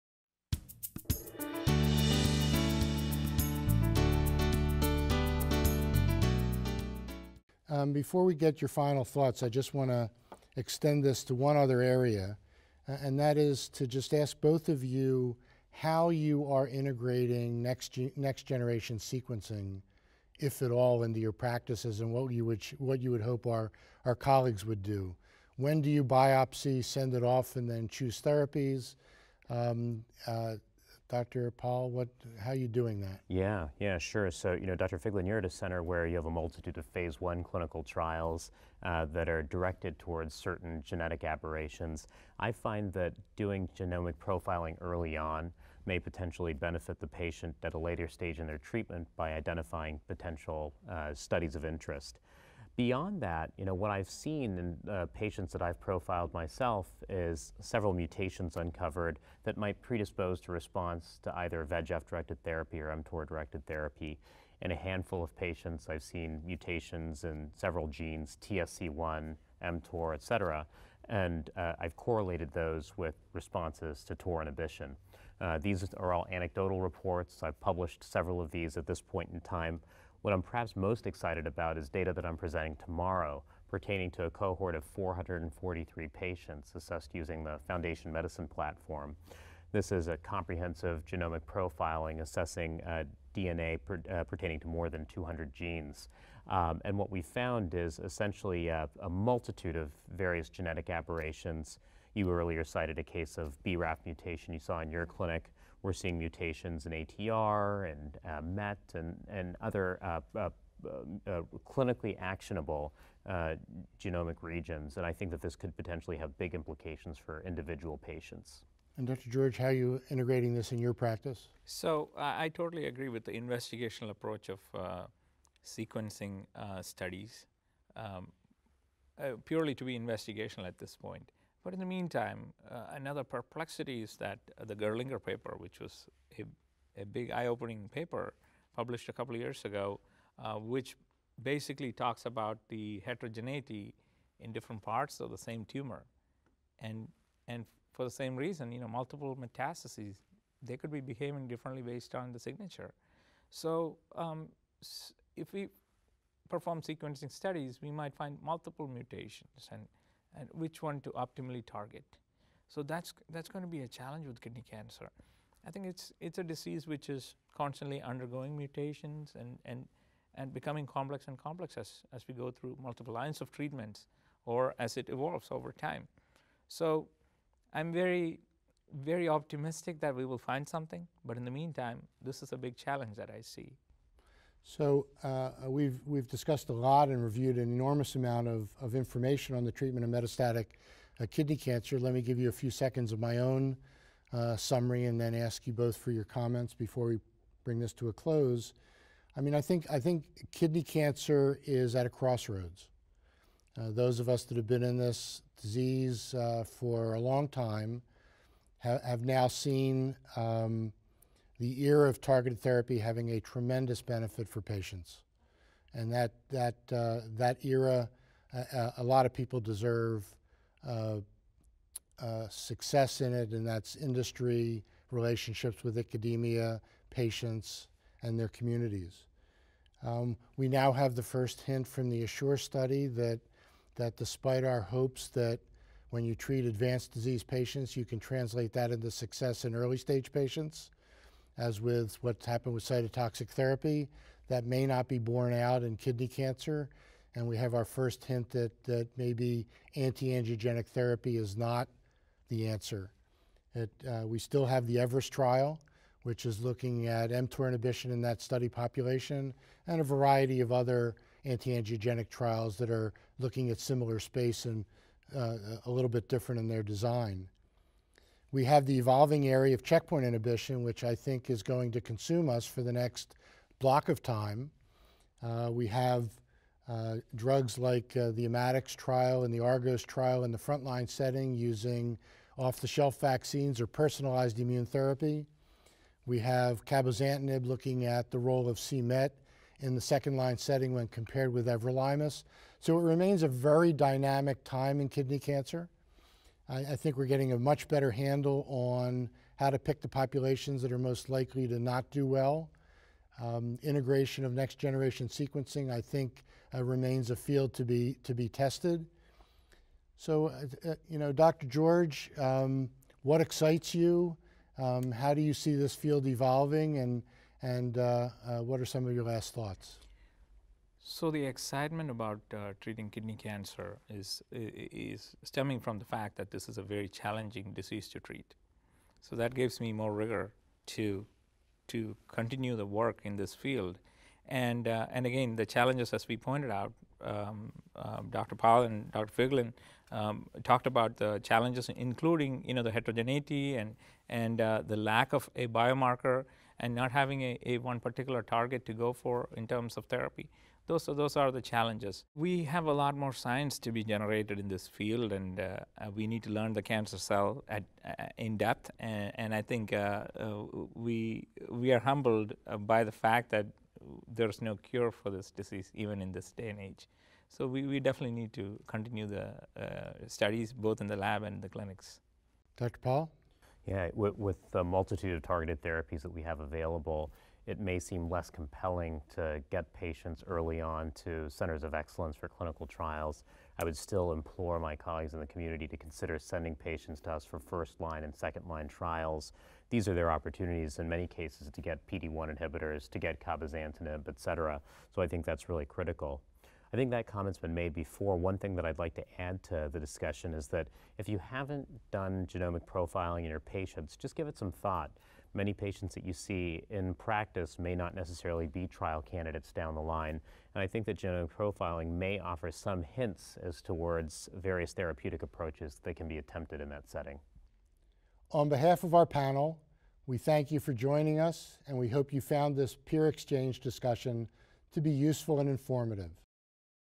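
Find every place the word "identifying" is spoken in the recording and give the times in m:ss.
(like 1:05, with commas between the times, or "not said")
0:49.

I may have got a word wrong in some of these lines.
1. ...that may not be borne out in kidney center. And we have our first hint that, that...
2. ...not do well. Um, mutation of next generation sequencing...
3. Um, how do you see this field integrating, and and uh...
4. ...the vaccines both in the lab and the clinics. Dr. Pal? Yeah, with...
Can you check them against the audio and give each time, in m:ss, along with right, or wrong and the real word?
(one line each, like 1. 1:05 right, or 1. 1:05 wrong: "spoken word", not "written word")
1. 4:04 wrong: "cancer", not "center"
2. 5:01 wrong: "integration", not "mutation"
3. 5:14 wrong: "evolving", not "integrating"
4. 6:09 wrong: "studies", not "vaccines".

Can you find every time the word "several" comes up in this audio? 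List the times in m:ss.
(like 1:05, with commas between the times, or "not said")
0:57, 1:07, 1:18.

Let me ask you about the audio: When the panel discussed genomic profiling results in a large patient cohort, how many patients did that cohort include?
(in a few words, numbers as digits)
443.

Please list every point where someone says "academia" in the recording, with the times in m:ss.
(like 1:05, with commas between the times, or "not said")
3:45.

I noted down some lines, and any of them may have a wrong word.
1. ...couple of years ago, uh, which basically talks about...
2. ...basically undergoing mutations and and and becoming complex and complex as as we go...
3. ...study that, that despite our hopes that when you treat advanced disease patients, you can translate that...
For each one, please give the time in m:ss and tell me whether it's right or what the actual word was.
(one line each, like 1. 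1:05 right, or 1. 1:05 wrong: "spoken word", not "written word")
1. 2:19 right
2. 2:47 wrong: "constantly", not "basically"
3. 3:52 right.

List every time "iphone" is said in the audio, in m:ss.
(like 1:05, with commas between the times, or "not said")
not said.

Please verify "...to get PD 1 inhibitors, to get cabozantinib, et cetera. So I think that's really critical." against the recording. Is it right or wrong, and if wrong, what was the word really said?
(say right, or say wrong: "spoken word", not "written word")
right.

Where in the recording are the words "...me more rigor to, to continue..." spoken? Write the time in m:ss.
5:29.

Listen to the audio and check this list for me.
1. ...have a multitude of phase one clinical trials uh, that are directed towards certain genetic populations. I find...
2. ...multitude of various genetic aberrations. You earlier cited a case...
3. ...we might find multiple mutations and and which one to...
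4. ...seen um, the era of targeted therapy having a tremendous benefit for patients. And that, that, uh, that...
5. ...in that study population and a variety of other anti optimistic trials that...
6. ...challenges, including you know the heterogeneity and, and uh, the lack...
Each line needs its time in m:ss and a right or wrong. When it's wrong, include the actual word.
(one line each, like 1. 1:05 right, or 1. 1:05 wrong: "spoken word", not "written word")
1. 0:36 wrong: "aberrations", not "populations"
2. 1:39 right
3. 2:37 right
4. 3:29 right
5. 4:18 wrong: "angiogenic", not "optimistic"
6. 5:41 right.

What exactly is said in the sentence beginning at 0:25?
When do you biopsy, send it off, and then choose therapies?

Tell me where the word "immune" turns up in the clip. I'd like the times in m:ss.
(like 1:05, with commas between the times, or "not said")
4:44.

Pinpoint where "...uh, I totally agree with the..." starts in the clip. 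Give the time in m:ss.
2:02.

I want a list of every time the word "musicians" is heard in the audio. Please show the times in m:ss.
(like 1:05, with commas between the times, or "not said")
not said.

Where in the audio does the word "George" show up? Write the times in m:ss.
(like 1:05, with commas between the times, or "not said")
1:59, 5:11.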